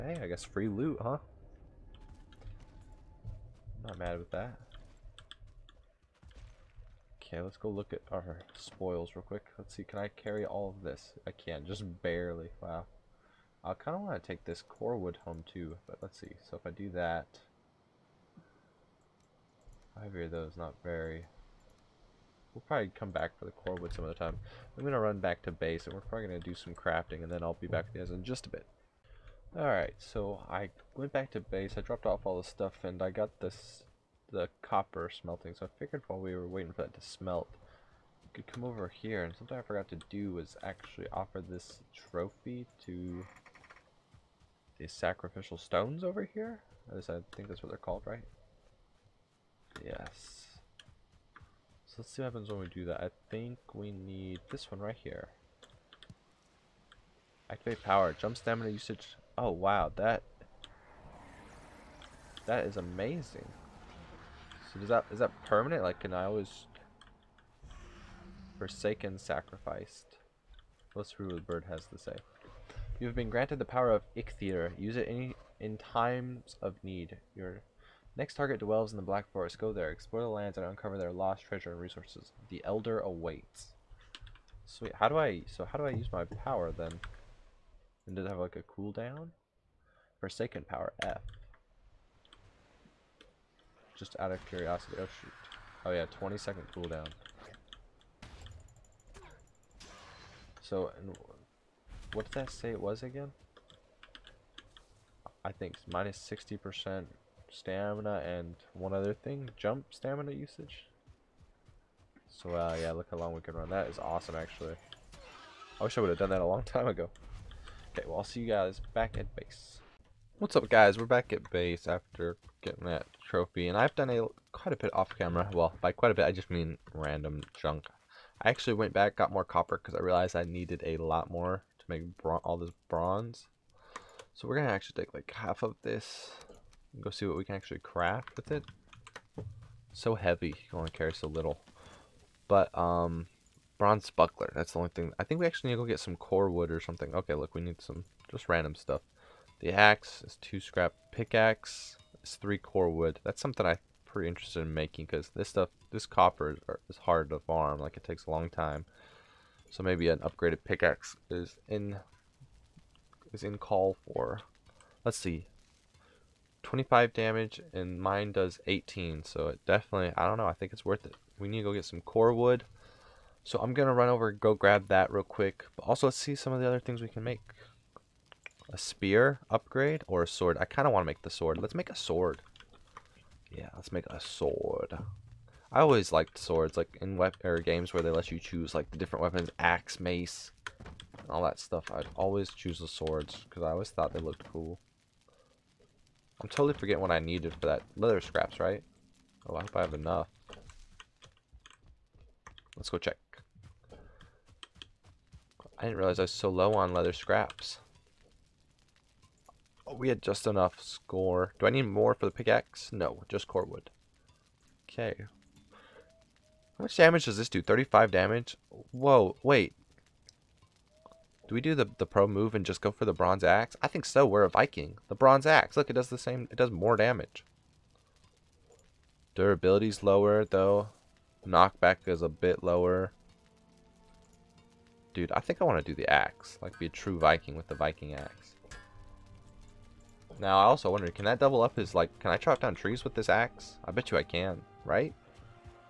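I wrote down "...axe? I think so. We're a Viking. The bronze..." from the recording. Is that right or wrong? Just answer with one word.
right.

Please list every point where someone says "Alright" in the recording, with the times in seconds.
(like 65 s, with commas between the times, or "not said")
29 s.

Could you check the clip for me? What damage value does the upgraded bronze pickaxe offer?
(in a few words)
25.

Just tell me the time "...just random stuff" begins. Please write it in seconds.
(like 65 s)
148 s.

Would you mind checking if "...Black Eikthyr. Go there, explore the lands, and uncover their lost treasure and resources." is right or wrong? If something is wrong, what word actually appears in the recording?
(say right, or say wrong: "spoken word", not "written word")
wrong: "Forest", not "Eikthyr".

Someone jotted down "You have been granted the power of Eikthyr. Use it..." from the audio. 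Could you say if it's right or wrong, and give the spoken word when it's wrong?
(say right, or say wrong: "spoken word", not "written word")
right.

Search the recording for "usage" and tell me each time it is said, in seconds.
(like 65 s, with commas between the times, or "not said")
58 s, 110 s.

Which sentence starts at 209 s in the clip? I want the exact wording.
Oh, we had just enough score.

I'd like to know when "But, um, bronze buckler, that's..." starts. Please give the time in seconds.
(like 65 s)
142 s.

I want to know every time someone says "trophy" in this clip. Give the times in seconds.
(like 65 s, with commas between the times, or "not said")
42 s, 123 s.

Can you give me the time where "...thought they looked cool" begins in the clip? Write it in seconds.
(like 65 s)
193 s.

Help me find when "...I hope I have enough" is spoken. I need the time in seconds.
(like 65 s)
199 s.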